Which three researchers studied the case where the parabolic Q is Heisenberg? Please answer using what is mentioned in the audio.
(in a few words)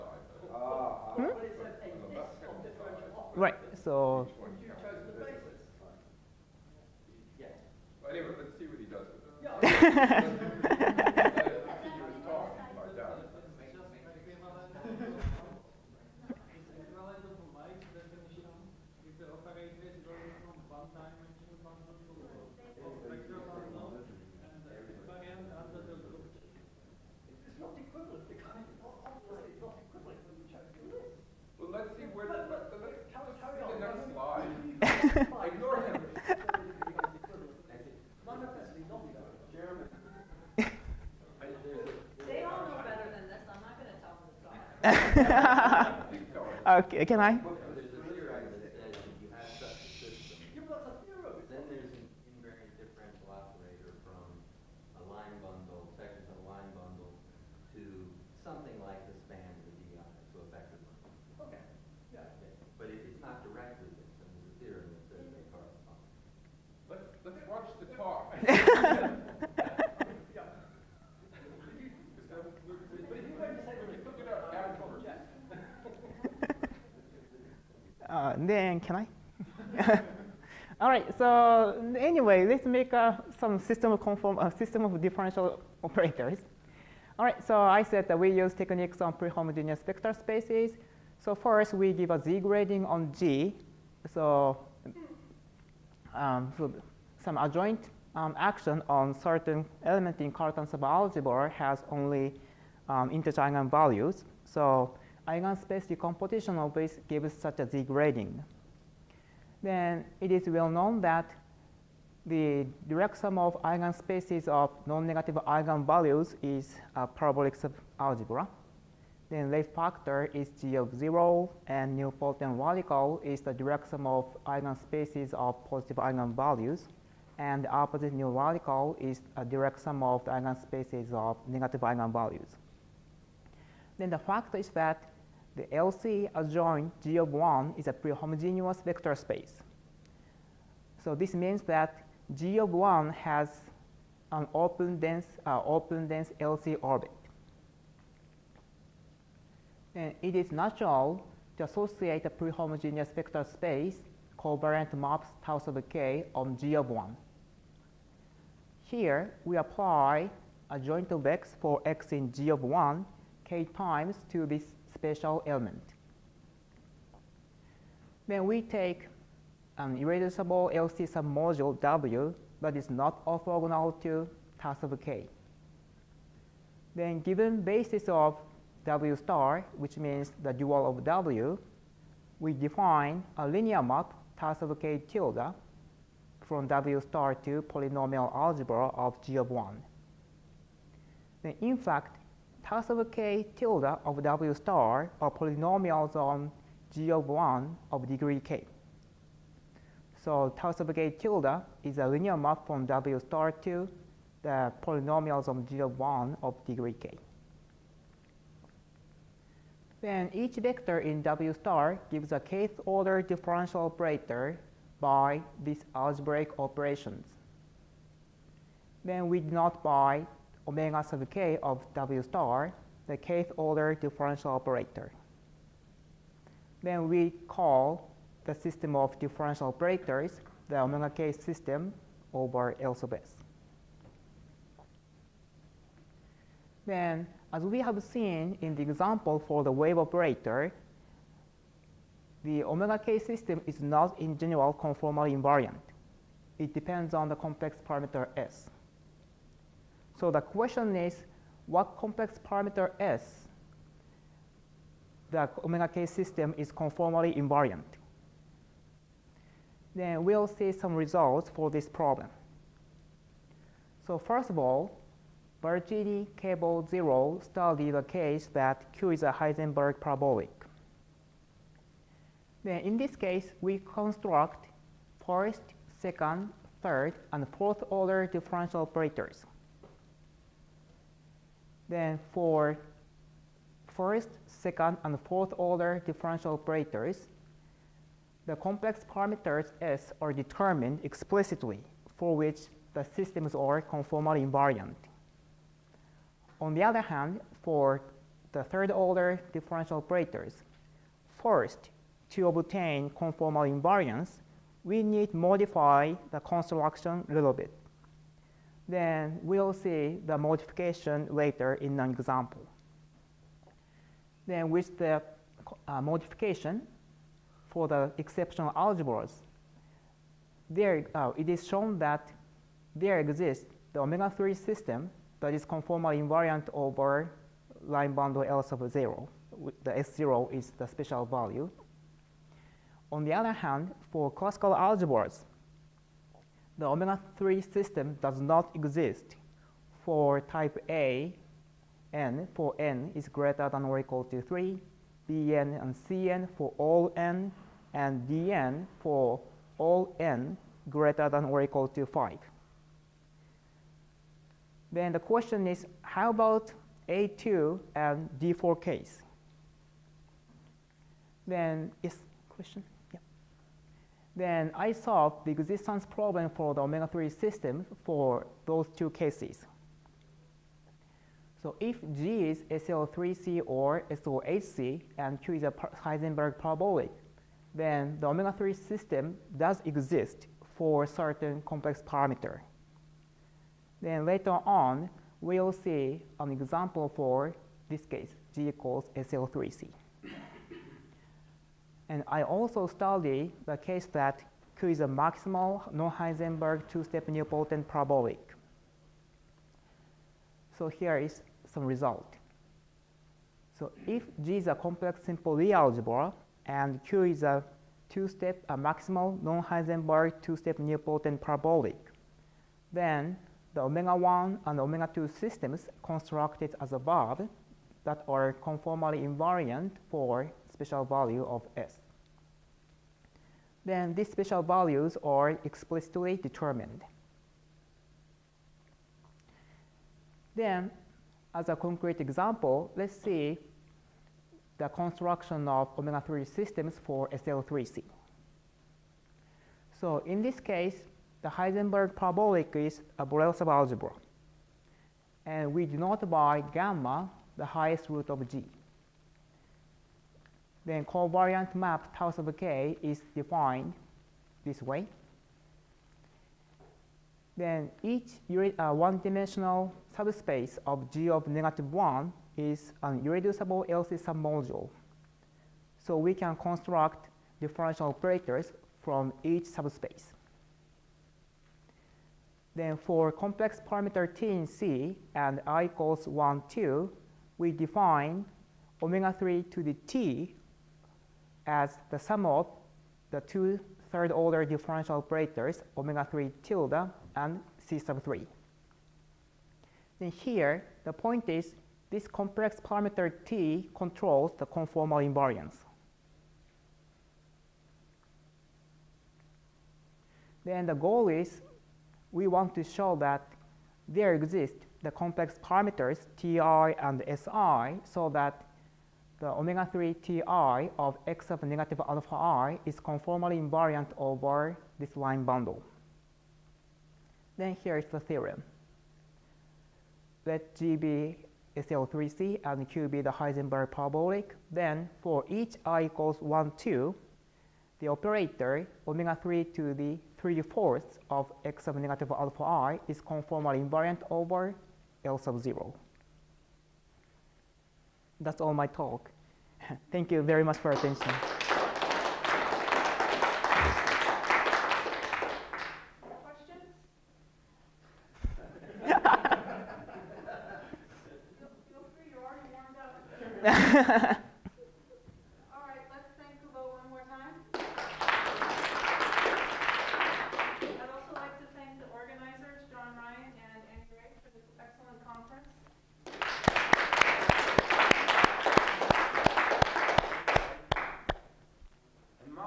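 Barchini, Kable, Zierau.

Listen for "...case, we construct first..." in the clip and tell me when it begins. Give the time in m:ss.
4:33.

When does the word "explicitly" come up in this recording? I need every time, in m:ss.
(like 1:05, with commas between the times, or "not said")
4:51, 7:05.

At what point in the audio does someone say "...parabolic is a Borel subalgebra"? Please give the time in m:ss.
7:22.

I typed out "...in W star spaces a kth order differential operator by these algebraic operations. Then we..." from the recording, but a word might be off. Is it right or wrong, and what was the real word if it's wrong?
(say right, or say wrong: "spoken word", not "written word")
wrong: "gives", not "spaces".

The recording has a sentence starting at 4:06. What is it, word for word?
It depends on the complex parameter s.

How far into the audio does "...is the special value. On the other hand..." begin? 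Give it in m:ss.
5:30.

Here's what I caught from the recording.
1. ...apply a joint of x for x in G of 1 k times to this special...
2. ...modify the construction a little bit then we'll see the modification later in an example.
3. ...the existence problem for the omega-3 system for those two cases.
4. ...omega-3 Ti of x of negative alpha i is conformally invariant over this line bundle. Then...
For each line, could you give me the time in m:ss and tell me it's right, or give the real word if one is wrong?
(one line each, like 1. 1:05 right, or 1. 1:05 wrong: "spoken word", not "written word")
1. 2:39 right
2. 5:05 right
3. 6:05 right
4. 8:29 right.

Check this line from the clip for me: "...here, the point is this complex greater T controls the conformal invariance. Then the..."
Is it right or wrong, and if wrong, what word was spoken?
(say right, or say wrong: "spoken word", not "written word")
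wrong: "parameter", not "greater".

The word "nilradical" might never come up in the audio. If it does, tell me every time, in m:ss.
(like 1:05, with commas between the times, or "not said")
2:08.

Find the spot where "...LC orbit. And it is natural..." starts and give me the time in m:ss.
2:26.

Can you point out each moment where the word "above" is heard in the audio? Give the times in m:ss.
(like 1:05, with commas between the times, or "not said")
6:56.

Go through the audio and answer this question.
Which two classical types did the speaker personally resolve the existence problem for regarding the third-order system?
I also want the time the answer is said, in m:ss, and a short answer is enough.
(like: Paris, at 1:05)
A2 and D4, at 5:57.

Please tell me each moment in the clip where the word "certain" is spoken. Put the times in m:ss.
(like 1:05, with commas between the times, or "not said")
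1:39, 6:21.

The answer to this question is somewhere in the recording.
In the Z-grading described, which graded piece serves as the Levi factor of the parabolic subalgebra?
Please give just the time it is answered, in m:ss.
2:00.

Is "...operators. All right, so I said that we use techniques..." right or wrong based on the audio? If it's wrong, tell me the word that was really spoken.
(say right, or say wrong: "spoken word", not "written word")
right.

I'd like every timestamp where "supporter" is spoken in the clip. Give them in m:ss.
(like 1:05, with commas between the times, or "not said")
not said.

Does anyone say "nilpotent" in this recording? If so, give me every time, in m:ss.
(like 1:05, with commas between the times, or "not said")
2:01, 6:37, 6:50.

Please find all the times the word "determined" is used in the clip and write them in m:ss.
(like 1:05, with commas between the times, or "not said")
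4:50, 7:06.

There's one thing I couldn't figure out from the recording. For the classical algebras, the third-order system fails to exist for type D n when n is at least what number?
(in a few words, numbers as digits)
5.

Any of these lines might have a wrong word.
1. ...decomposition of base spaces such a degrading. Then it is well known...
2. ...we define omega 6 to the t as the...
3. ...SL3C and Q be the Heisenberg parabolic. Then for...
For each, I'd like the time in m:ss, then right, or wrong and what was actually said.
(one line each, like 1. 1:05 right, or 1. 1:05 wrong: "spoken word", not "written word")
1. 1:45 wrong: "gives", not "spaces"
2. 7:57 wrong: "3", not "6"
3. 8:41 right.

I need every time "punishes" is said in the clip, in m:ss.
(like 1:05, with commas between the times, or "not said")
not said.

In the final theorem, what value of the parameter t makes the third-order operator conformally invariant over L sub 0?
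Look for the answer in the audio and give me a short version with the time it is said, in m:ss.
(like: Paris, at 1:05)
3/4, at 8:50.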